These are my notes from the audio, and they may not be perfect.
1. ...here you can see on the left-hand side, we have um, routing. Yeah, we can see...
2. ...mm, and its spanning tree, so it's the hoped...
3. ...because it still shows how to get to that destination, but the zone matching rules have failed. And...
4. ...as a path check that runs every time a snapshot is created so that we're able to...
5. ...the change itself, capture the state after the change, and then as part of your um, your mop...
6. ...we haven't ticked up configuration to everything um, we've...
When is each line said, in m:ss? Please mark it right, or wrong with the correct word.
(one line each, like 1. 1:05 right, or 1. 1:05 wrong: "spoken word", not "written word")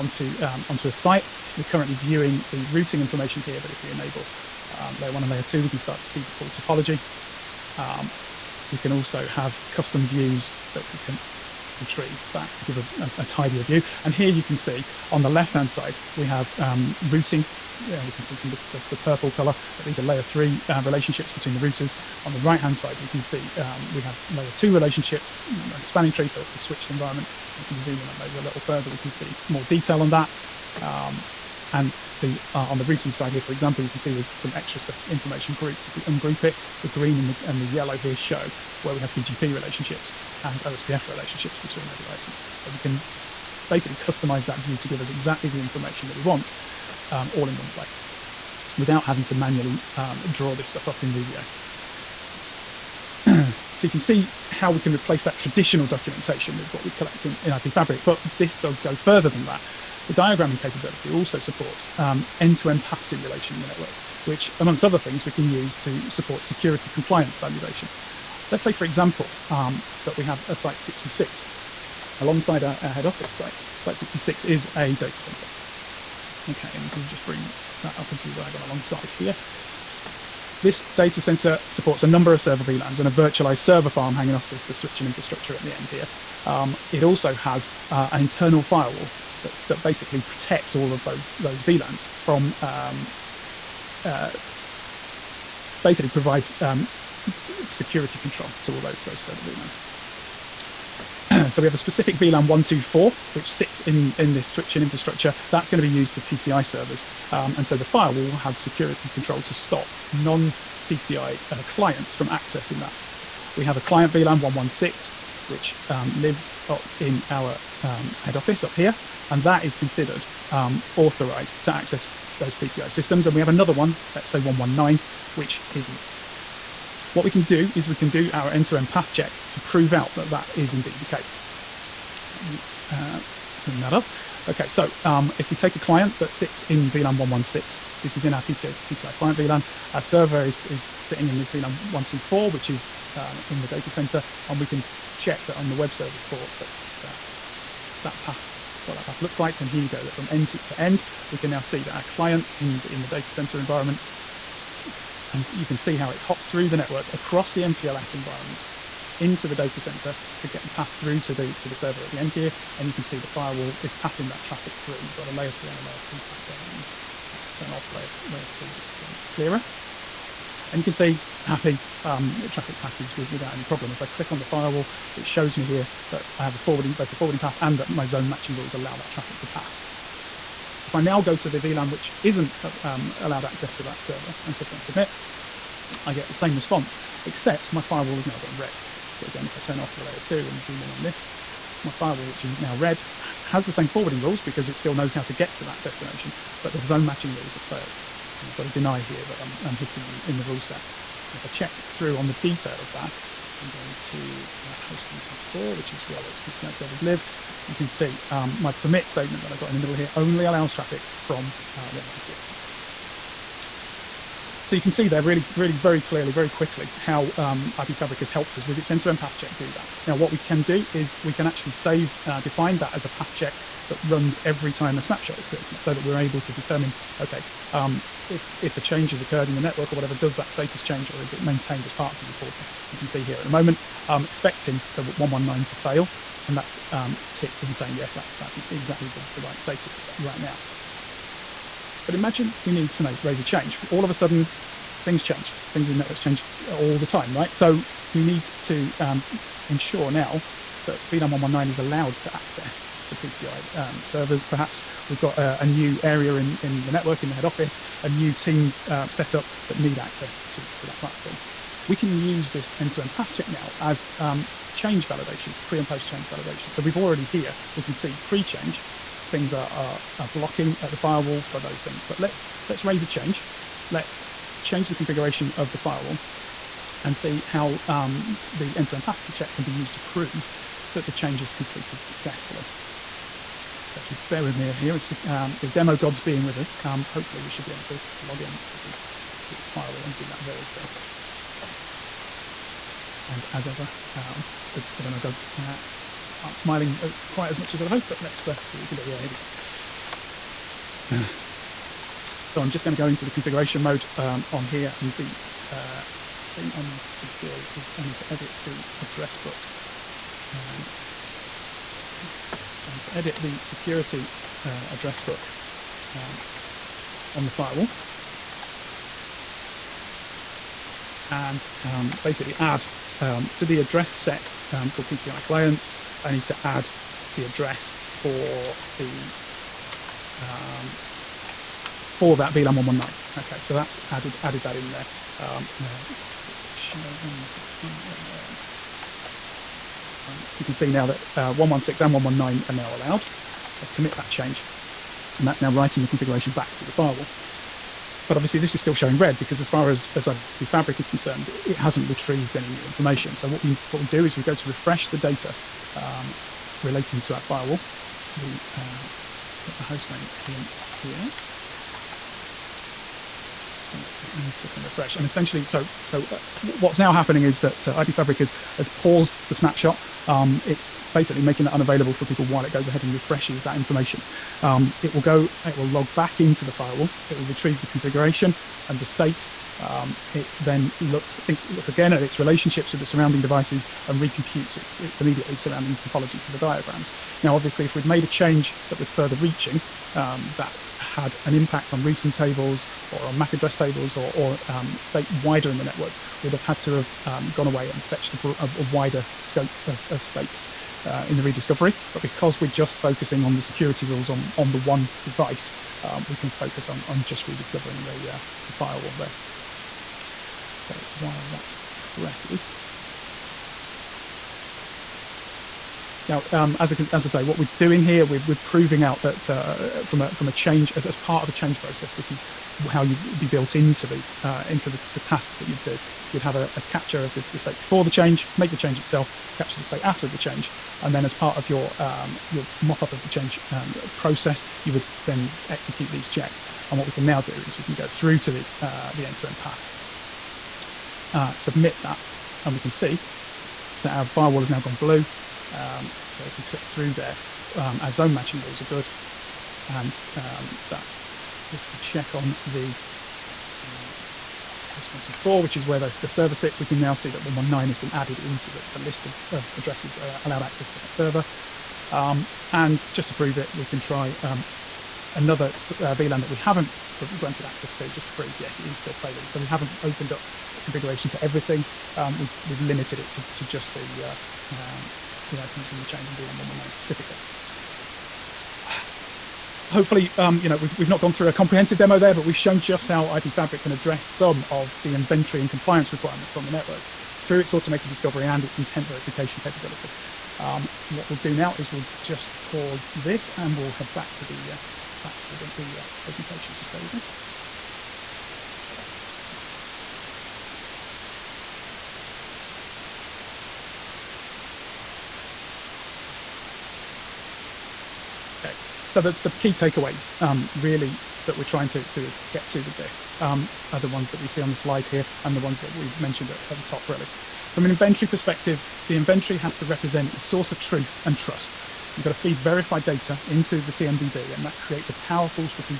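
1. 0:14 right
2. 0:25 wrong: "switched", not "hoped"
3. 3:14 wrong: "knows", not "shows"
4. 3:42 right
5. 7:08 right
6. 7:49 wrong: "opened", not "ticked".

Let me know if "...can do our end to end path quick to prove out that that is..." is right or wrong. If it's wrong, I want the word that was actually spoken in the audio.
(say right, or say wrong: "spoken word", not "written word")
wrong: "check", not "quick".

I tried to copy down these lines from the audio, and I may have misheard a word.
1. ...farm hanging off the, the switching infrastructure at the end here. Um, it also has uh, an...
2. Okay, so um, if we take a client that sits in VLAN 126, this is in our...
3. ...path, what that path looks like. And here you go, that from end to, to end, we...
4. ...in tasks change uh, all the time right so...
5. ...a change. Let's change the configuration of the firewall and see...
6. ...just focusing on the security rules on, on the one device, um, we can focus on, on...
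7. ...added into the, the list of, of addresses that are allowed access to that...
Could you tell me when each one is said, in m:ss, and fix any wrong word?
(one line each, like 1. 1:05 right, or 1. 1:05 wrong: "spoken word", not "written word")
1. 1:23 right
2. 2:14 wrong: "116", not "126"
3. 2:28 right
4. 4:05 wrong: "networks", not "tasks"
5. 4:33 right
6. 6:42 right
7. 7:38 right.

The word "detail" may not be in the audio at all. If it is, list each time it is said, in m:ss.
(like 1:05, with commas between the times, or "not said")
0:29, 3:22.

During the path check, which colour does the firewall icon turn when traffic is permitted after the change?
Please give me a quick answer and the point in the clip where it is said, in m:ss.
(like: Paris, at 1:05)
blue, at 7:24.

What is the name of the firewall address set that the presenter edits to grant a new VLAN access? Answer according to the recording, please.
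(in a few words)
PCI clients.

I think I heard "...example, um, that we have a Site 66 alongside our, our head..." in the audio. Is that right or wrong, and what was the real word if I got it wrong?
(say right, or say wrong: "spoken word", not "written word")
right.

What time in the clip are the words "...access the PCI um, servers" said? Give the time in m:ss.
4:12.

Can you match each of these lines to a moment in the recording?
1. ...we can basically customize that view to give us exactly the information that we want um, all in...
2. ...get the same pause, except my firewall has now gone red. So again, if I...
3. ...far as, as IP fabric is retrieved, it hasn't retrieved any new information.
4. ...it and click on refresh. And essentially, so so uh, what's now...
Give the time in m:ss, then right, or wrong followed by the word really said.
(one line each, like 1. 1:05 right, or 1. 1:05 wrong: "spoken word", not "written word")
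1. 0:42 right
2. 3:06 wrong: "response", not "pause"
3. 5:49 wrong: "concerned", not "retrieved"
4. 6:04 right.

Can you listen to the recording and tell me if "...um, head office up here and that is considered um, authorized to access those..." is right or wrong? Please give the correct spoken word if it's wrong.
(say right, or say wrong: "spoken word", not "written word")
right.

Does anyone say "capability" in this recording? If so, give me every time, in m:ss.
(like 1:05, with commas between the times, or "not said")
1:00, 8:09.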